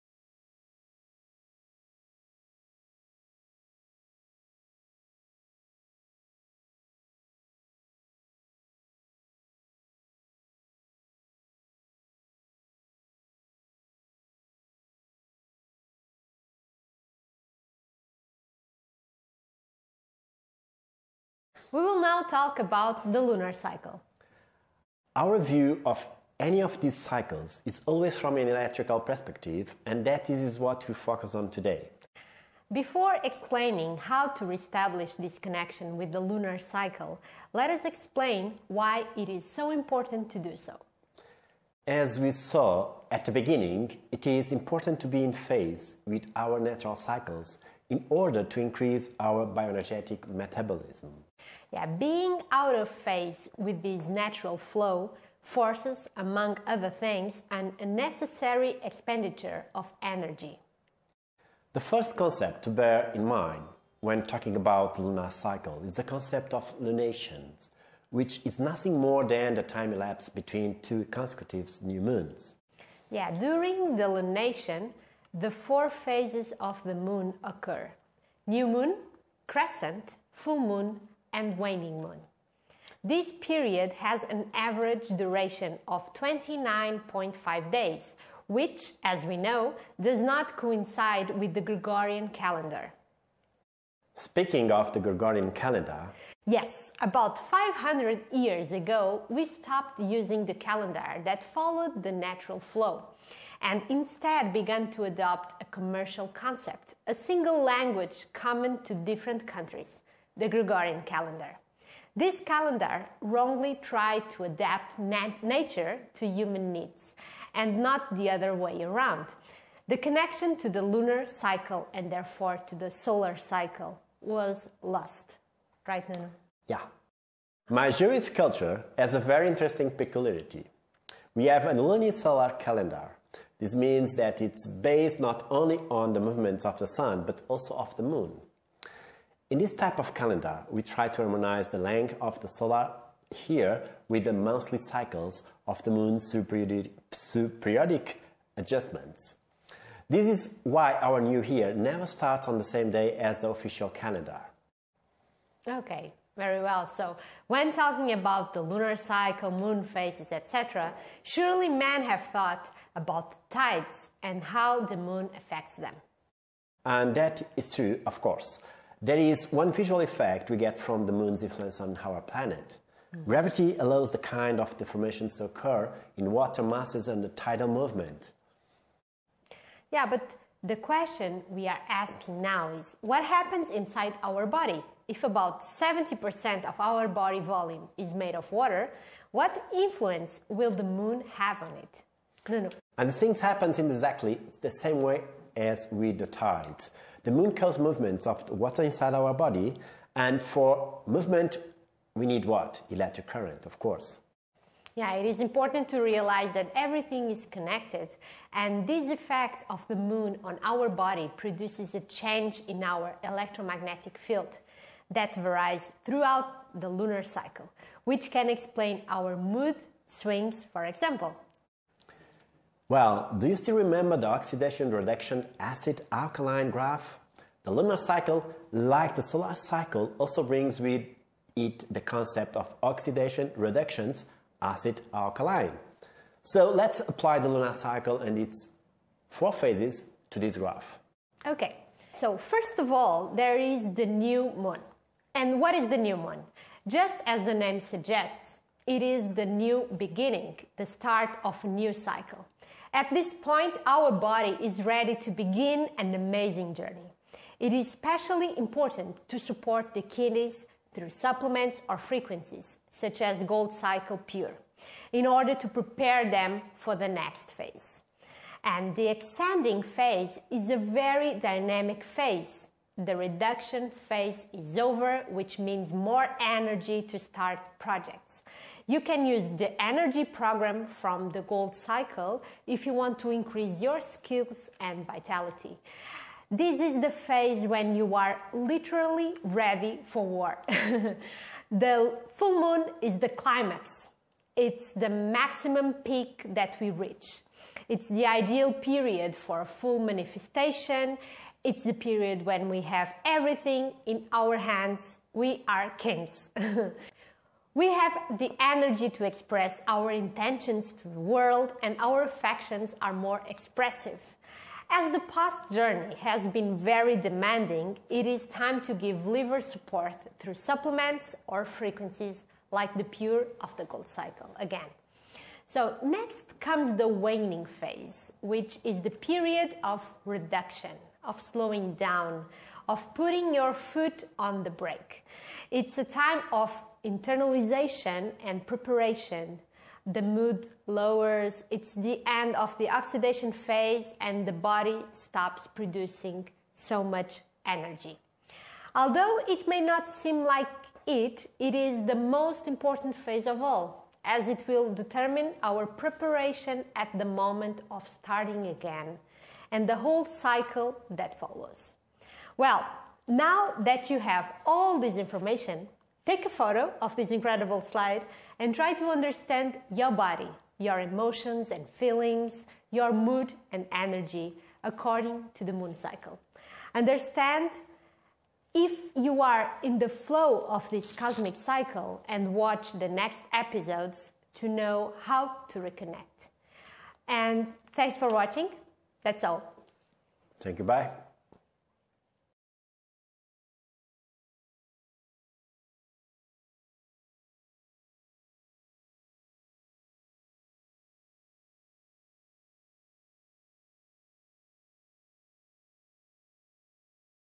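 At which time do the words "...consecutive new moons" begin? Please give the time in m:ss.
1:11.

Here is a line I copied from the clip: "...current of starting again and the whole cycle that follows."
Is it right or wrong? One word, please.
wrong.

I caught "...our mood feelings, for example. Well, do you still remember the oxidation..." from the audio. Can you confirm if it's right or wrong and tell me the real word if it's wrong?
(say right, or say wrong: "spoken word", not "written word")
wrong: "swings", not "feelings".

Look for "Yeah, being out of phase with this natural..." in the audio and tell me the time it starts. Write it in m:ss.
0:51.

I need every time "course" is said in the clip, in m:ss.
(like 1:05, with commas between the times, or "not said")
2:48, 3:23.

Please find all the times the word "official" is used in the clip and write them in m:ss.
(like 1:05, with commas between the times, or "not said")
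2:33.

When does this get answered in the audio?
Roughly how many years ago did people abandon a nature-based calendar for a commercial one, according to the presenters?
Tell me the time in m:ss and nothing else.
1:37.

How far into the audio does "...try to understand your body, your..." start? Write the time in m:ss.
6:08.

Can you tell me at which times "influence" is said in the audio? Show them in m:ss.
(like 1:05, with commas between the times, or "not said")
2:51, 3:09.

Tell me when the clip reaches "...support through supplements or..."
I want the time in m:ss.
5:19.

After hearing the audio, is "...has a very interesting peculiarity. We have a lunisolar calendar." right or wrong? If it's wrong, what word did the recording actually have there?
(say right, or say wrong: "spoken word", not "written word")
right.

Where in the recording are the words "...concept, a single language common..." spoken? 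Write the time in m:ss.
1:46.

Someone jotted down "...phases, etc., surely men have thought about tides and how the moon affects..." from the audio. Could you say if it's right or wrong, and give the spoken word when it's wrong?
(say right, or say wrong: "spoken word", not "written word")
right.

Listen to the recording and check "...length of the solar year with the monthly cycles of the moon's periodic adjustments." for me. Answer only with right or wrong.
right.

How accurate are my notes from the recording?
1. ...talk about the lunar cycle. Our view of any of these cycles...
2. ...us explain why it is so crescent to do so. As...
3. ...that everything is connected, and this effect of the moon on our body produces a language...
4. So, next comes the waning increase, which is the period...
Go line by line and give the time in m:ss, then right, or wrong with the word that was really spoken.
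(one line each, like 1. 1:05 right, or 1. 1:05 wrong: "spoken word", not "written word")
1. 0:22 right
2. 0:37 wrong: "important", not "crescent"
3. 3:26 wrong: "change", not "language"
4. 5:25 wrong: "phase", not "increase".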